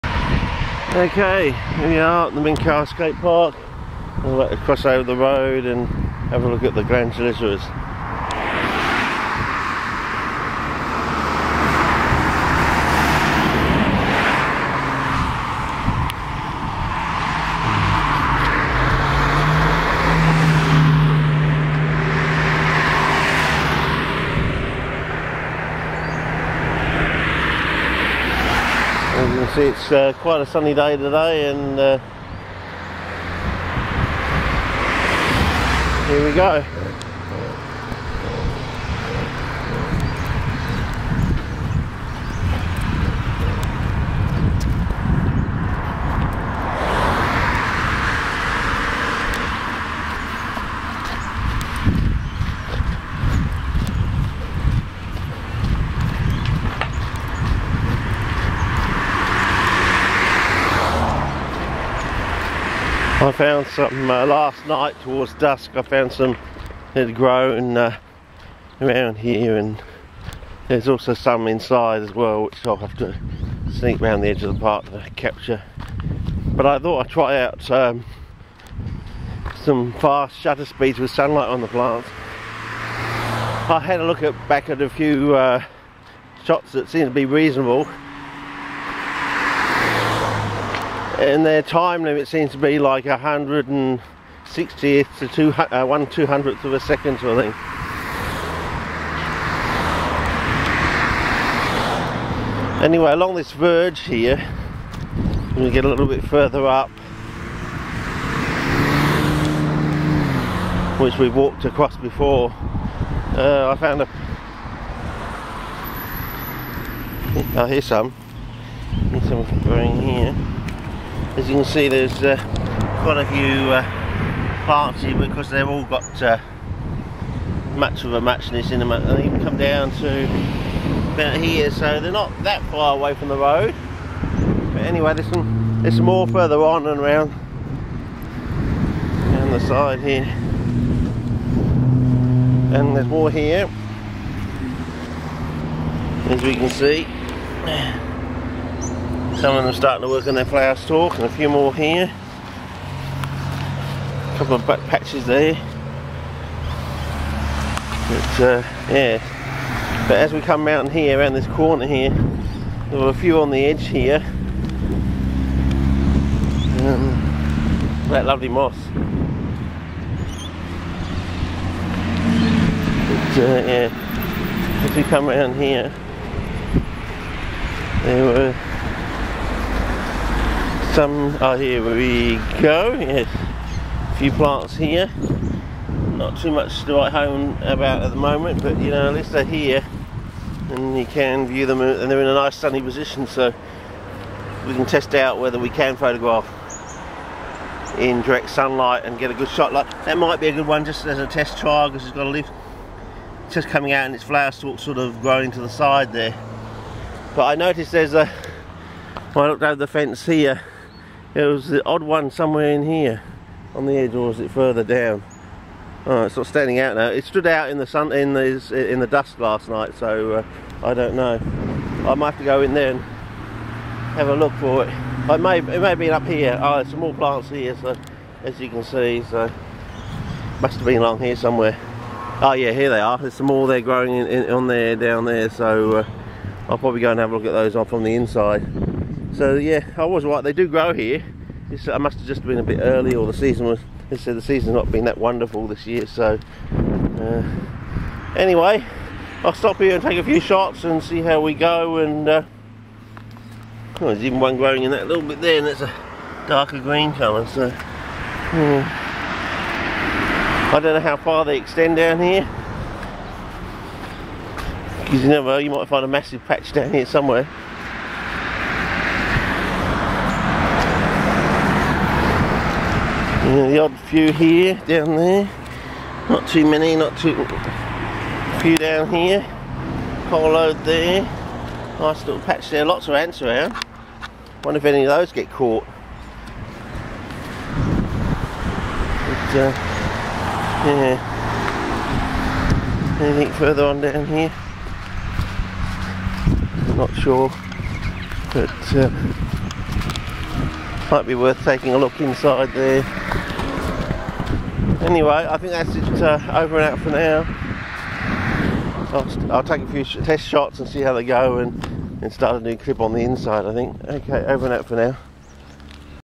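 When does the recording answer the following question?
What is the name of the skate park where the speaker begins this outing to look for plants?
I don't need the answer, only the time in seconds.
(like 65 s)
2 s.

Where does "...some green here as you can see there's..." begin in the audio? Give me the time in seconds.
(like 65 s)
119 s.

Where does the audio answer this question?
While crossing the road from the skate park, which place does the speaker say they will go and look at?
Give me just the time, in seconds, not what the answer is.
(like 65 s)
6 s.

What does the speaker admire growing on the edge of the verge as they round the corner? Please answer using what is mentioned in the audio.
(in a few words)
Moss.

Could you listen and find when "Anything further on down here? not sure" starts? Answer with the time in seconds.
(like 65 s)
293 s.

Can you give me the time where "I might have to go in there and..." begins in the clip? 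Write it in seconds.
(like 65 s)
222 s.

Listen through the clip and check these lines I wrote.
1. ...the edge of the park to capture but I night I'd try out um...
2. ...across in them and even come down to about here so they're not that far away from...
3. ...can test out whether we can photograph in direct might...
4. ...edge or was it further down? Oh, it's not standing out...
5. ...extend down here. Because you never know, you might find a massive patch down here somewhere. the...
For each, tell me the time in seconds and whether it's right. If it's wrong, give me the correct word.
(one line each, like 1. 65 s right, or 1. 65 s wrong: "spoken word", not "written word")
1. 74 s wrong: "thought", not "night"
2. 128 s wrong: "matchness", not "across"
3. 194 s wrong: "sunlight", not "might"
4. 213 s right
5. 261 s right.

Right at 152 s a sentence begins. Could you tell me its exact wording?
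A couple of back patches there.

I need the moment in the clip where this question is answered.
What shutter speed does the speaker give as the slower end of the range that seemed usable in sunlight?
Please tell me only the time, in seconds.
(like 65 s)
93 s.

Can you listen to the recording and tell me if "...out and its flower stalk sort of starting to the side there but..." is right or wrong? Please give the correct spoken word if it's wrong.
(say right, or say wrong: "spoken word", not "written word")
wrong: "growing", not "starting".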